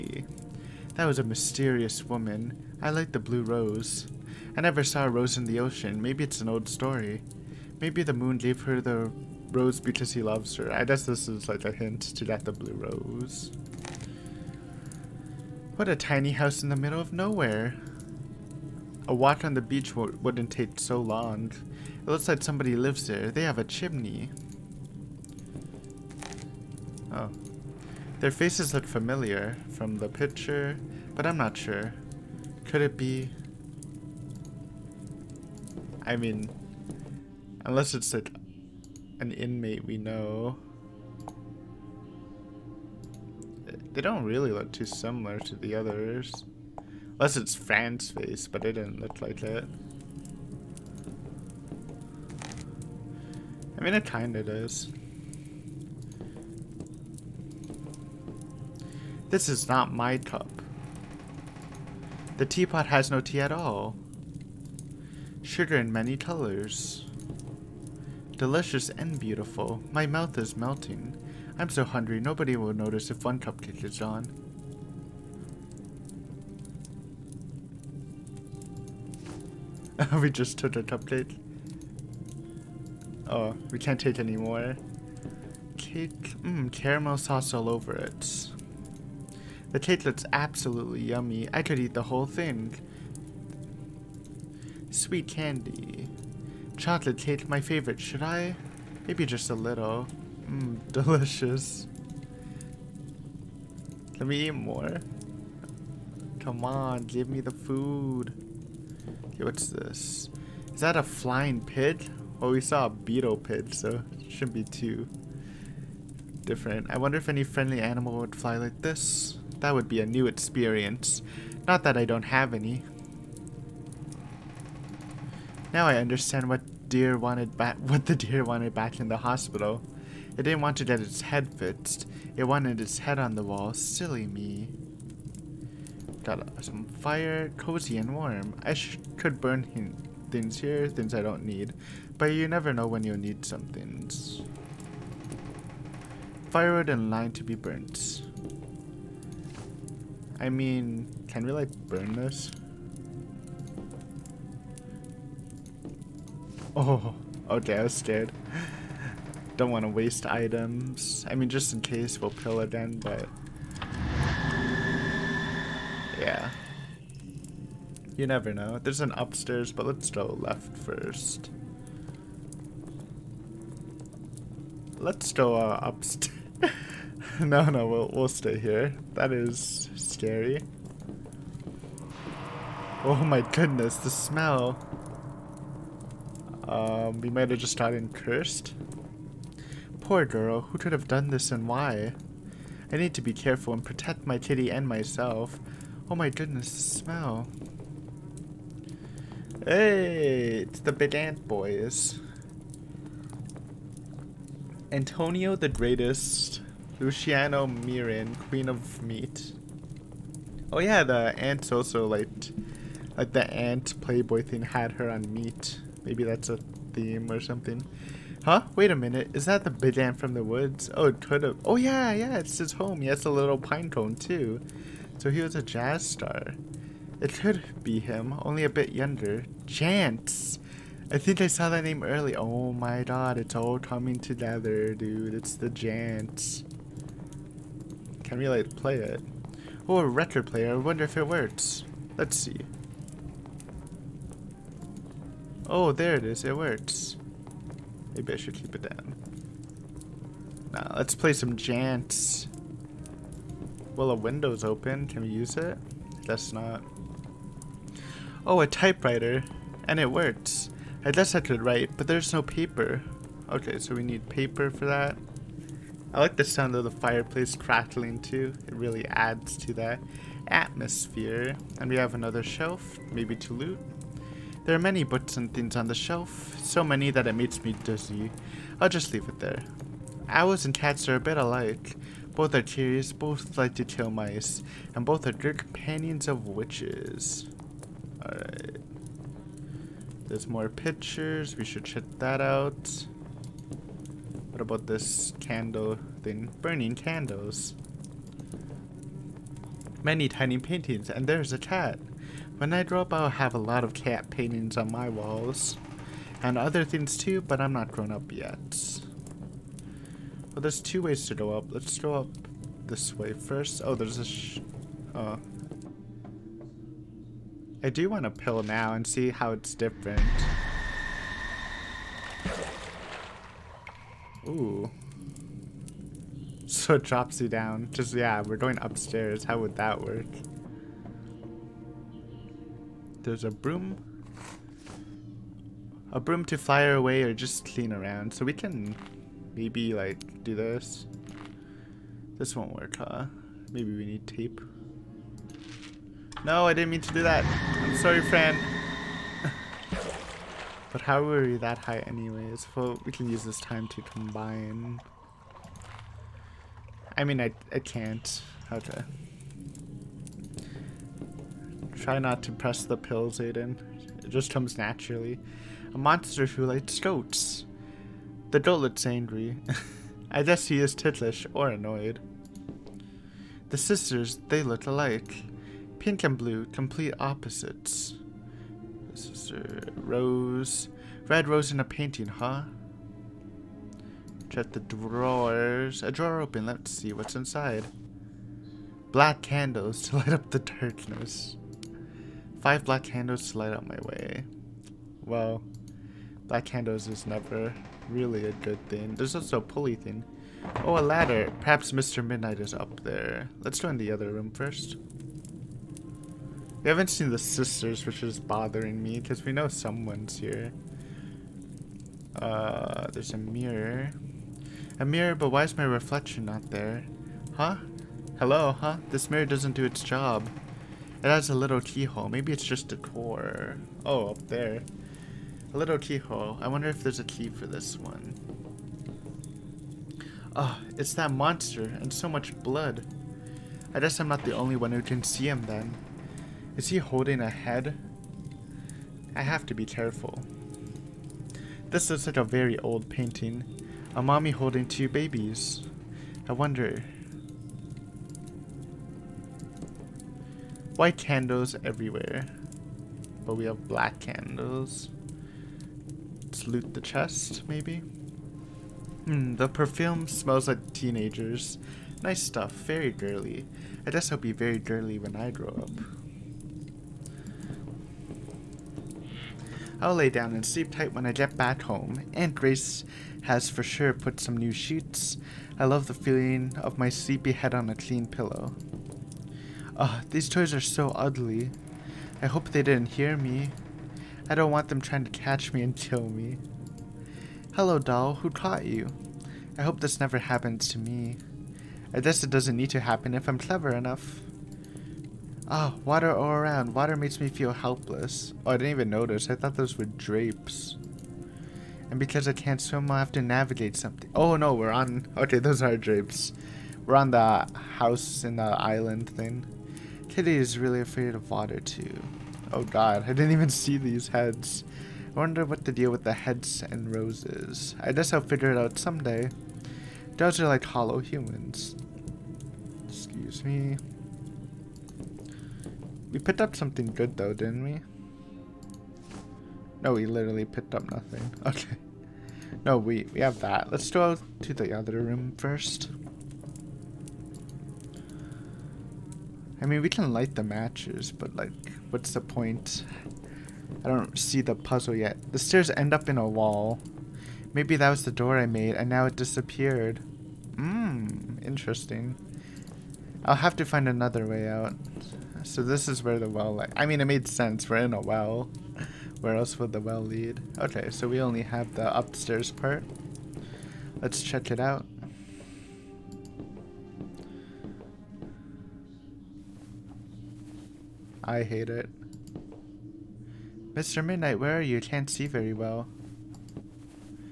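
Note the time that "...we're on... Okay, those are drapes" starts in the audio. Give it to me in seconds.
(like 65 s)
504 s.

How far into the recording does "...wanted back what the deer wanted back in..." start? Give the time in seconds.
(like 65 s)
127 s.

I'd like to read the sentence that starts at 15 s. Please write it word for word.
What a tiny house in the middle of nowhere.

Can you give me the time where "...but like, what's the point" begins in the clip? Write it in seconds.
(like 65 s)
541 s.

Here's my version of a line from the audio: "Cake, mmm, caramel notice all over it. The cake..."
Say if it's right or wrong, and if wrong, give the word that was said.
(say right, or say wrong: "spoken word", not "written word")
wrong: "sauce", not "notice".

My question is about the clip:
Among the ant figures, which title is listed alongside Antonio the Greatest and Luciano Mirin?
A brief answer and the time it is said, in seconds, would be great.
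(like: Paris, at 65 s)
Queen of Meat, at 208 s.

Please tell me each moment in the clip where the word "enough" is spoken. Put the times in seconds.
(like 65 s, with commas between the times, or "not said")
493 s.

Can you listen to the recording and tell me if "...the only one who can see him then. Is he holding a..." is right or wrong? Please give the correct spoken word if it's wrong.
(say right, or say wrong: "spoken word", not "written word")
right.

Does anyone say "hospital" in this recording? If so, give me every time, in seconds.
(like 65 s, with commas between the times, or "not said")
129 s.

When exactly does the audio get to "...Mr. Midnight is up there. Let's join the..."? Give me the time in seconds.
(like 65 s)
401 s.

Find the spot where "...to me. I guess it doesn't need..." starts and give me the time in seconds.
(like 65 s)
490 s.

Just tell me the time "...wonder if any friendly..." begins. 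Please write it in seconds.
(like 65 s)
116 s.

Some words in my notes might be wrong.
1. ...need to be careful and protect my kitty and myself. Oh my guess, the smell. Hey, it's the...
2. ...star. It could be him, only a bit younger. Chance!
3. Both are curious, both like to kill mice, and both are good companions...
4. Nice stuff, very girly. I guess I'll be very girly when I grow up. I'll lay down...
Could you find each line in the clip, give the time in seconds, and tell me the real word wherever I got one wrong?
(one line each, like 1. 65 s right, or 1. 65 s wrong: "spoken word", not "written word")
1. 192 s wrong: "goodness", not "guess"
2. 226 s right
3. 282 s right
4. 462 s right.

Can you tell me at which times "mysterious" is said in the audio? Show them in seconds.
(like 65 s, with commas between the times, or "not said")
1 s.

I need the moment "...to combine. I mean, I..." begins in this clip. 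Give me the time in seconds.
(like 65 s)
353 s.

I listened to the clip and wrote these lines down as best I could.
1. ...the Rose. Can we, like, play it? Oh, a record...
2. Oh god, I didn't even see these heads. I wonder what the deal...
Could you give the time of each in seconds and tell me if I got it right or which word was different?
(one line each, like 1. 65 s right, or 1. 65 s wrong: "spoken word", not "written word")
1. 235 s wrong: "Jants", not "Rose"
2. 512 s right.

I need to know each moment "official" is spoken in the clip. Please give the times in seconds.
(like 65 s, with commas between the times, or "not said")
not said.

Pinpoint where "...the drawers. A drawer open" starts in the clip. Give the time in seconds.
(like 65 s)
384 s.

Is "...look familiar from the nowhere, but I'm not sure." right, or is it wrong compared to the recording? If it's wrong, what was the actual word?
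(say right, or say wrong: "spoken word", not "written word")
wrong: "picture", not "nowhere".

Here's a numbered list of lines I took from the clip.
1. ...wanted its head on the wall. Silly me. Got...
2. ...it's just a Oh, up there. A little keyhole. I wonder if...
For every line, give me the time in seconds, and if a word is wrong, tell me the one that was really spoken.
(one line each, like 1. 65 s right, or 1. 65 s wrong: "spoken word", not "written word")
1. 132 s right
2. 422 s right.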